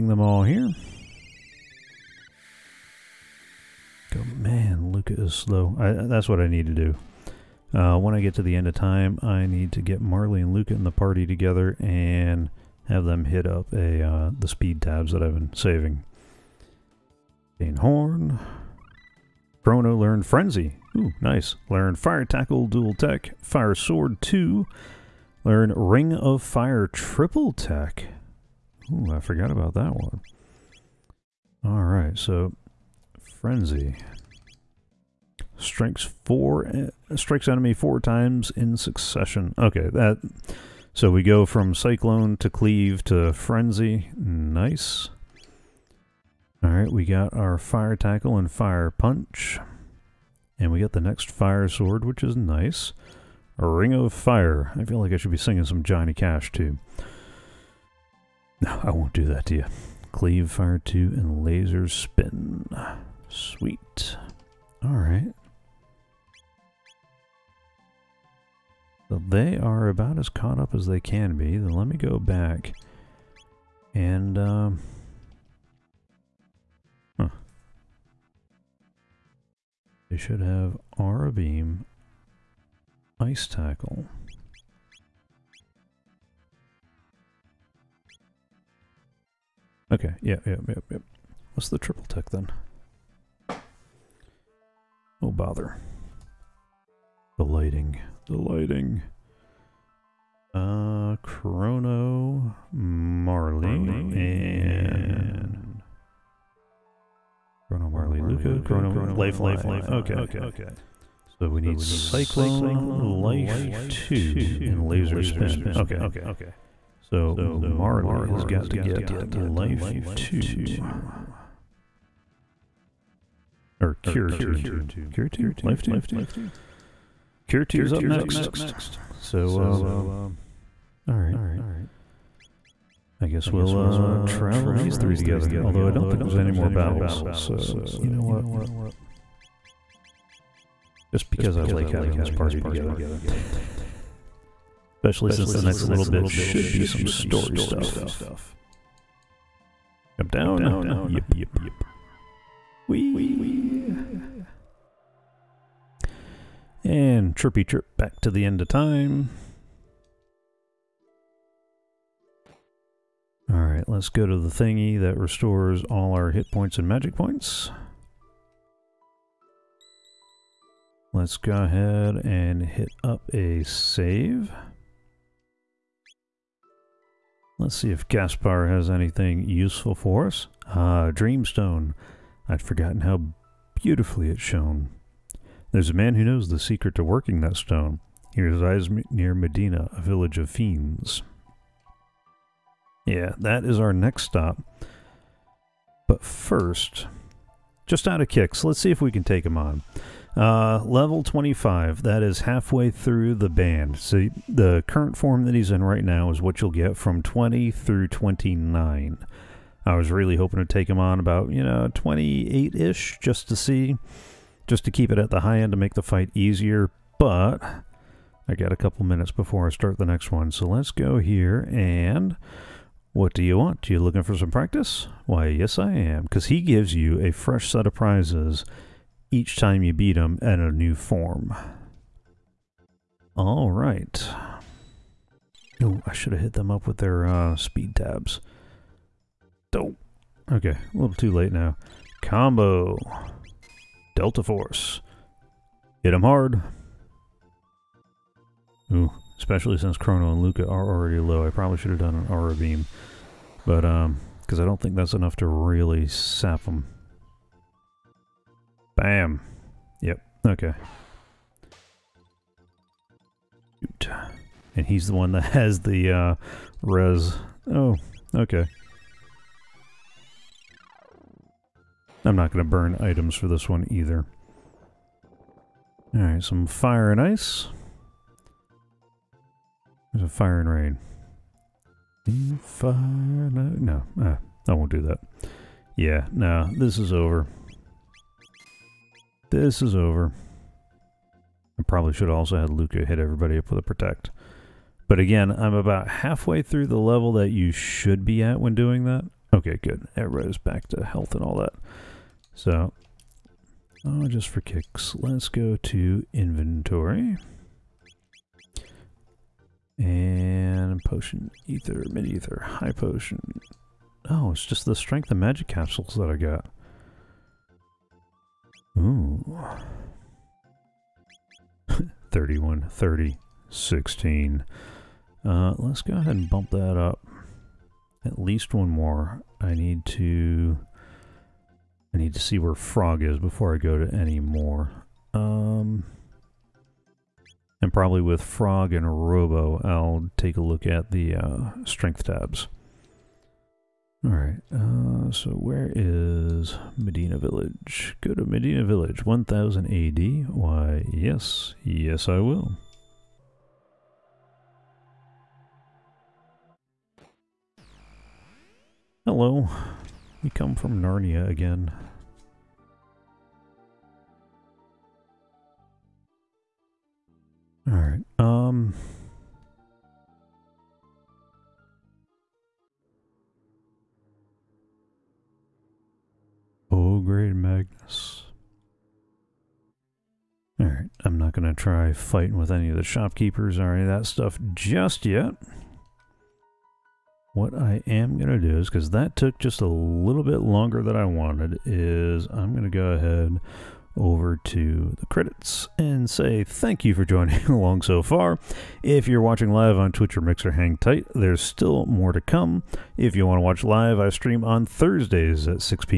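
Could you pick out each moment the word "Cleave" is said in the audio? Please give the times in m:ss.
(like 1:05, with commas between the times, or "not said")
0:42, 1:00.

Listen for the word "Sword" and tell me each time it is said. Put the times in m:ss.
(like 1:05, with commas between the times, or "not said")
0:23, 0:51.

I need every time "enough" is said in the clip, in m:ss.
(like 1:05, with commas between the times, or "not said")
4:15.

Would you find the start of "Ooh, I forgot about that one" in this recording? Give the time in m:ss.
0:28.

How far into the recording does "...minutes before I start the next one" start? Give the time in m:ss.
3:39.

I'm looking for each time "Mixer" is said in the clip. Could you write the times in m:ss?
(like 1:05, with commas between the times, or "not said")
6:40.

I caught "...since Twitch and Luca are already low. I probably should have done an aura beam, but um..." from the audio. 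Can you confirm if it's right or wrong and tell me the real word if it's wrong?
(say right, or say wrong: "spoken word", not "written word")
wrong: "Chrono", not "Twitch".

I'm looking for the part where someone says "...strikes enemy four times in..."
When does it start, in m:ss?
0:37.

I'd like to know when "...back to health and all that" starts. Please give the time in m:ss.
5:00.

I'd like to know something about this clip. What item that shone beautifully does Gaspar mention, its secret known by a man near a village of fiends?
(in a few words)
Dreamstone.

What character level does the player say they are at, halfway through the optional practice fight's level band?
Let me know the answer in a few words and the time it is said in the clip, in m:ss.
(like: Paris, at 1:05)
25, at 3:21.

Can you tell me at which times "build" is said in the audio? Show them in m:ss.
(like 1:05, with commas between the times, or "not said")
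not said.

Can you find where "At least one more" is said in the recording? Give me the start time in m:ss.
5:28.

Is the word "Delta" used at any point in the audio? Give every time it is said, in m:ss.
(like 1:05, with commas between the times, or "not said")
4:04.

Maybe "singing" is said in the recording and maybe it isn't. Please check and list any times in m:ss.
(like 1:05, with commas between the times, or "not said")
0:55.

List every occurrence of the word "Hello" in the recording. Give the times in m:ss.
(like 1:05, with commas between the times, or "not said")
5:59.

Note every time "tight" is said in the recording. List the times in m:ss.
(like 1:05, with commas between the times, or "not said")
6:40.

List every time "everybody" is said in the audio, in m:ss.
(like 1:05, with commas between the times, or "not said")
4:53, 5:00.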